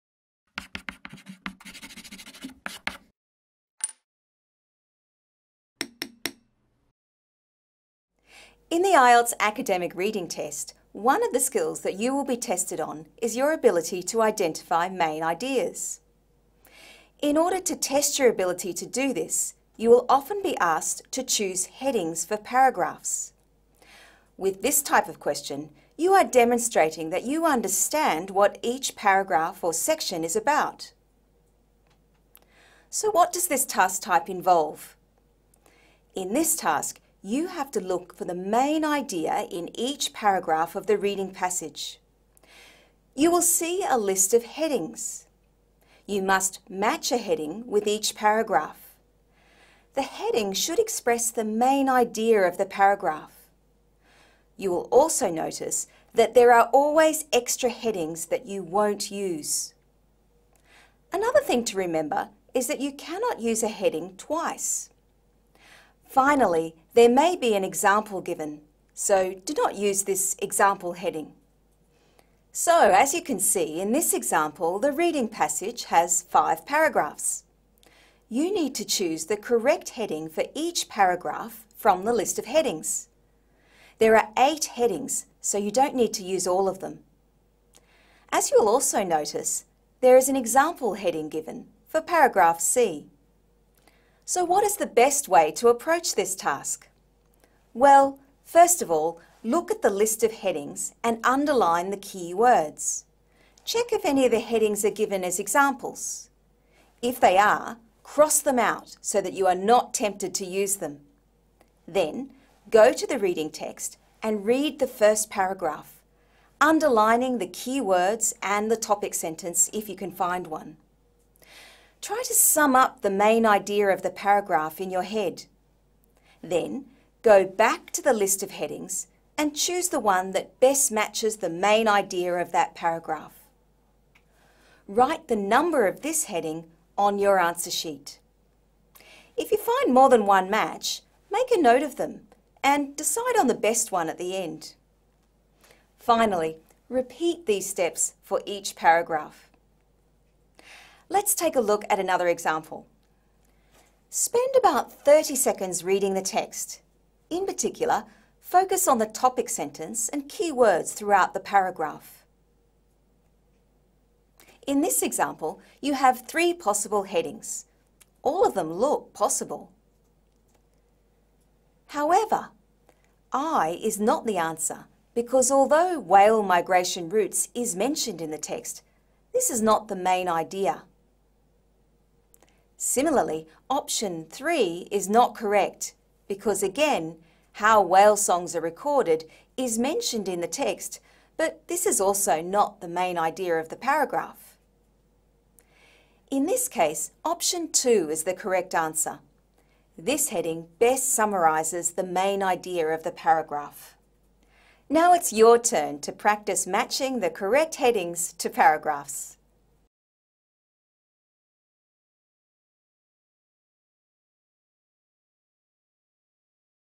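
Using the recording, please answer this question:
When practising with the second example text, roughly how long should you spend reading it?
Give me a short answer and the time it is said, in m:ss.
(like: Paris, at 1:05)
30 seconds, at 2:35.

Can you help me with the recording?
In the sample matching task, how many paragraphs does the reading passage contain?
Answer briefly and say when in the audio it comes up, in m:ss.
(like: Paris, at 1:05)
5, at 1:16.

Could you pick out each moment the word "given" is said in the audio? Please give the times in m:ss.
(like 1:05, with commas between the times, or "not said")
1:08, 1:31, 1:44.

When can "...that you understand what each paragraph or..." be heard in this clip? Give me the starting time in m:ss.
0:27.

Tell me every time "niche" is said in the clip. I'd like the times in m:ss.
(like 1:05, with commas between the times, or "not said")
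not said.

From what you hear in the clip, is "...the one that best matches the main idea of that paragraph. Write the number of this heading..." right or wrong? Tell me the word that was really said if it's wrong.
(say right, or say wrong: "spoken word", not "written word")
right.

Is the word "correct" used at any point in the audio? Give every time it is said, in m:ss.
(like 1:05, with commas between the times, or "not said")
1:19, 3:05, 3:18, 3:27.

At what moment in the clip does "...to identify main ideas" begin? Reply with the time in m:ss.
0:14.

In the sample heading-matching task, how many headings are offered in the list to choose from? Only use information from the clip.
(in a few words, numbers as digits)
8.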